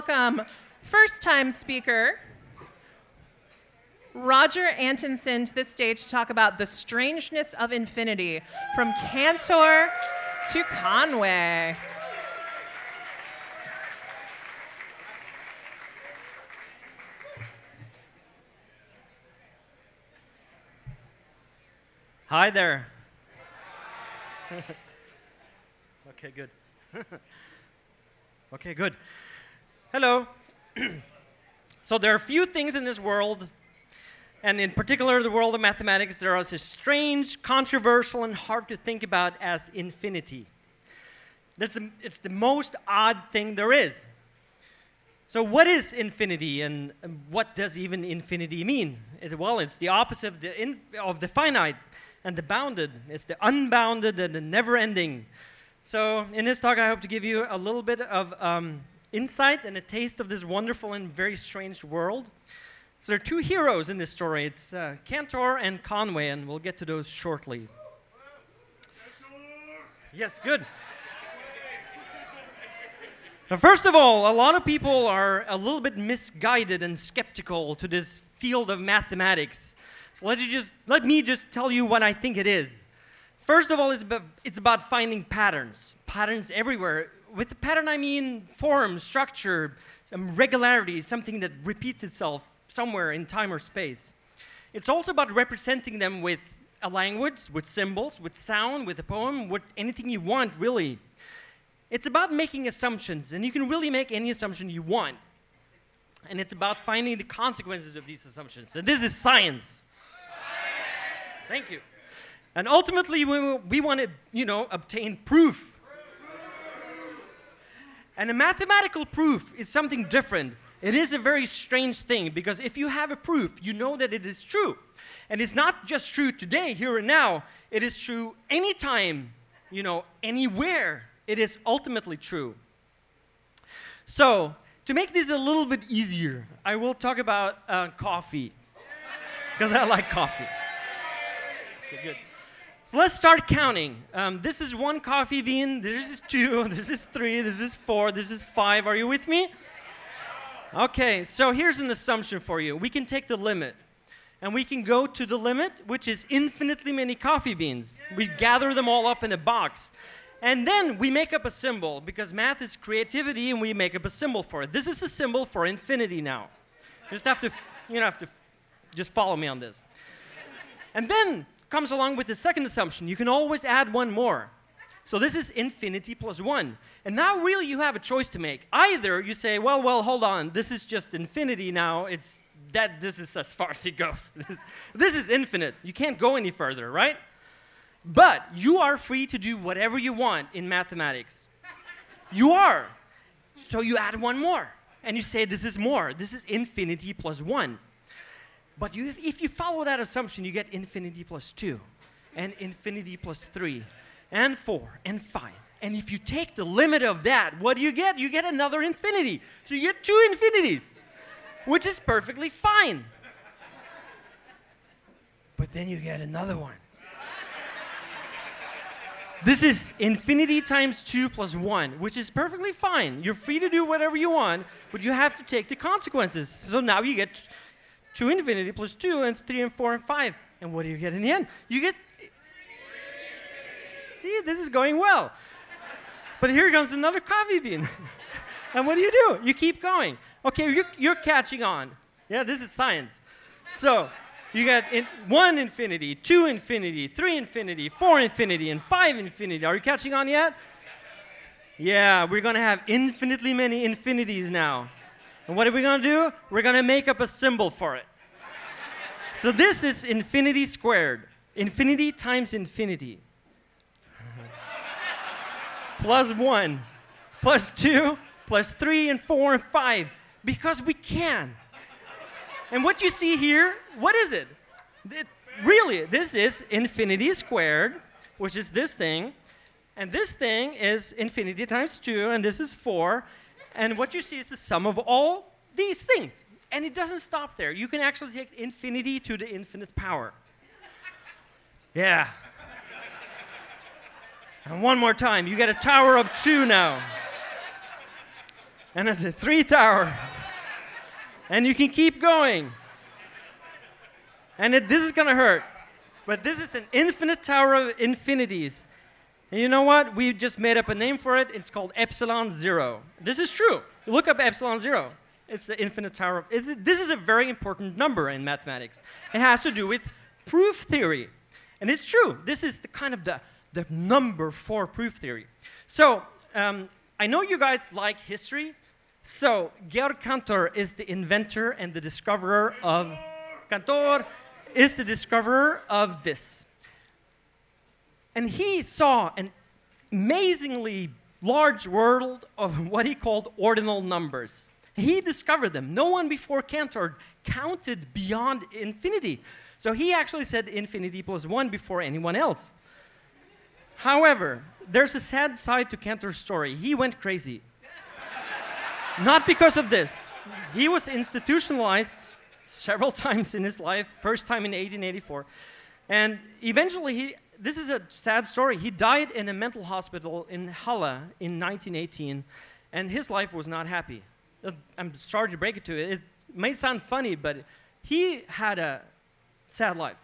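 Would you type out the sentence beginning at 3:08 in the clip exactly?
But you are free to do whatever you want in mathematics.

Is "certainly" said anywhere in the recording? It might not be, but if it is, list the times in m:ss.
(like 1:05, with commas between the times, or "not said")
not said.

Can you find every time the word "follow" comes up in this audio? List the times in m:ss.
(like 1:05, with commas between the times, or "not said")
2:49, 3:19.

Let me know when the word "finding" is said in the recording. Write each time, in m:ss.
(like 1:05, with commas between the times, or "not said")
1:24, 1:46.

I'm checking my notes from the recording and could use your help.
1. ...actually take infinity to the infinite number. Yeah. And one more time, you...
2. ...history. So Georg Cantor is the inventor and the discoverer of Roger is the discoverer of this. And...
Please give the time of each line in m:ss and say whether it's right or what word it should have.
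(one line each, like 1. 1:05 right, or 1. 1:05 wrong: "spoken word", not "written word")
1. 4:48 wrong: "power", not "number"
2. 5:28 wrong: "Cantor", not "Roger".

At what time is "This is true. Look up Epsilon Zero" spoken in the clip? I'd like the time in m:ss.
5:13.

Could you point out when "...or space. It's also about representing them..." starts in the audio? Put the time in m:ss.
1:33.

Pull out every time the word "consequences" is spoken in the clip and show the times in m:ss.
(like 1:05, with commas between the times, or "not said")
1:47, 3:45.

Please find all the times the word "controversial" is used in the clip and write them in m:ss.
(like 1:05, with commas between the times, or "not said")
0:37.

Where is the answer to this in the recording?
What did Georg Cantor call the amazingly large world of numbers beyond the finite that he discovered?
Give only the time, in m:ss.
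5:43.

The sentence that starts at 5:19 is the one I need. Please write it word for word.
It has to do with proof theory.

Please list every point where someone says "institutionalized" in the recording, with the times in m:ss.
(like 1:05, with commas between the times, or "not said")
6:01.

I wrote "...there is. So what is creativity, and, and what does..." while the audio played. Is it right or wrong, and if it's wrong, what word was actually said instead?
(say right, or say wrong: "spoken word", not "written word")
wrong: "infinity", not "creativity".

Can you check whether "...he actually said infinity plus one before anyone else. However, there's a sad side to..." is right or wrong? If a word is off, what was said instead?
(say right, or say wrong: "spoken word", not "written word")
right.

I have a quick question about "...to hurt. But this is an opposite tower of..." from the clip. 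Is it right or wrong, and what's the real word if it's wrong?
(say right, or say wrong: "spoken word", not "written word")
wrong: "infinite", not "opposite".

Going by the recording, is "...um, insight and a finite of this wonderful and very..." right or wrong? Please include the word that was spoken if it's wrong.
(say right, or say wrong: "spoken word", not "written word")
wrong: "taste", not "finite".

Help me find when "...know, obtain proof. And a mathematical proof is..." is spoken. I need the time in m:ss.
1:54.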